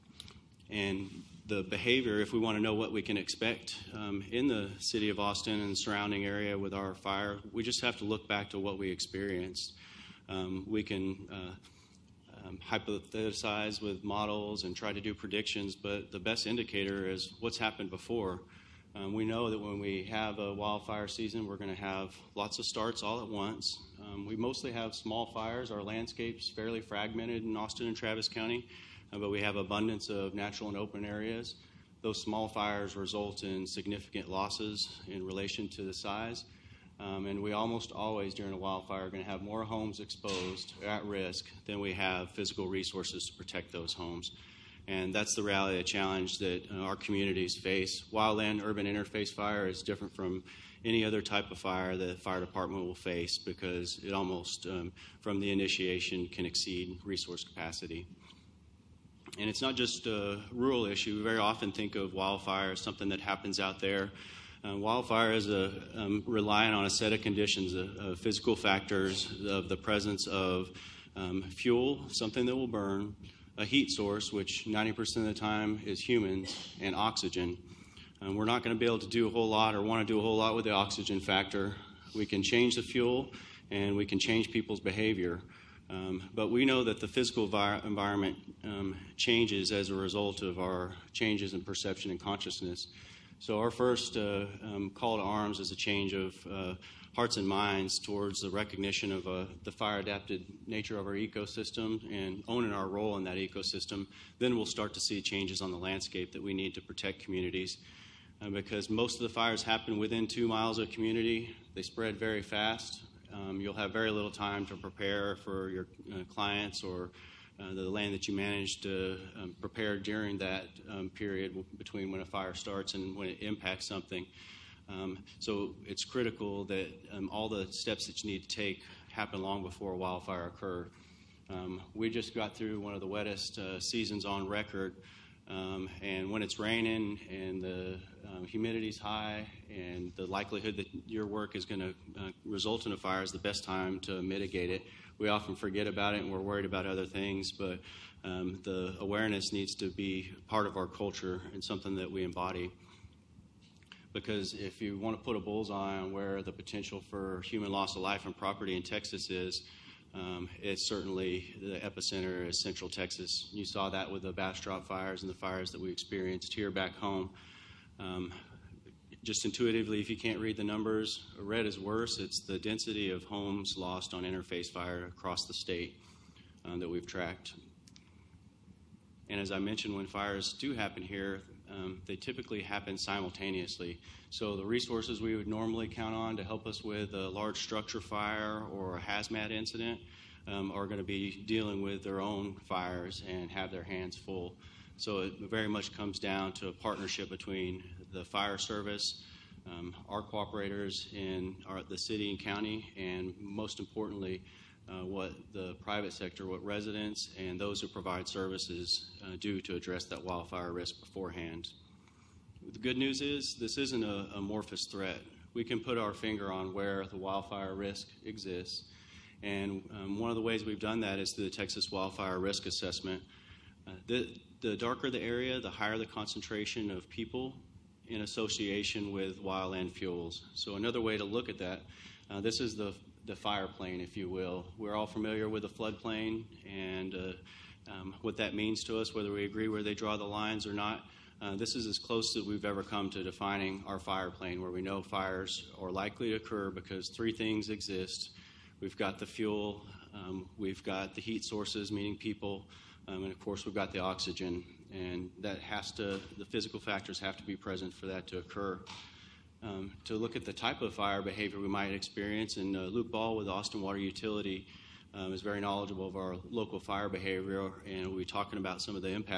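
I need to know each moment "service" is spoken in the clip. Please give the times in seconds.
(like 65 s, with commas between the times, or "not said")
198 s, 208 s.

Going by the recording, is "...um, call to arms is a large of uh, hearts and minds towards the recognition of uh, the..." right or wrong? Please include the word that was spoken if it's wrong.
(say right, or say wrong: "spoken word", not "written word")
wrong: "change", not "large".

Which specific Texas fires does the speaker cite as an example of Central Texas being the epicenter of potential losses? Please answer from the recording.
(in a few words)
Bastrop fires.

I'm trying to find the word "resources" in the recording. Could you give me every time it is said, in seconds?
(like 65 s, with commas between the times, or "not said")
42 s, 57 s, 184 s.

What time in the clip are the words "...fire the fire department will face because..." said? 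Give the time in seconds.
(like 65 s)
51 s.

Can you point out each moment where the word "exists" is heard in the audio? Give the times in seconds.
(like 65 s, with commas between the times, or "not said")
218 s, 247 s.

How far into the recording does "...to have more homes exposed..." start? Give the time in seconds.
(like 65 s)
39 s.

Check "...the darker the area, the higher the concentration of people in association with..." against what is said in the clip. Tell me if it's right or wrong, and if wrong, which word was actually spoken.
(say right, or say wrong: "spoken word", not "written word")
right.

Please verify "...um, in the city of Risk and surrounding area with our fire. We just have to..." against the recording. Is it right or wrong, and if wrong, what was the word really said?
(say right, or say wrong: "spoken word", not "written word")
wrong: "Austin", not "Risk".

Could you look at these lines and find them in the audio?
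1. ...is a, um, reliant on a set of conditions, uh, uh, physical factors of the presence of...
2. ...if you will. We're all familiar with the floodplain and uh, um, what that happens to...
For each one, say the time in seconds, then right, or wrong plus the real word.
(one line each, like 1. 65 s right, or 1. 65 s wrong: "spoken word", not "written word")
1. 65 s right
2. 234 s wrong: "means", not "happens".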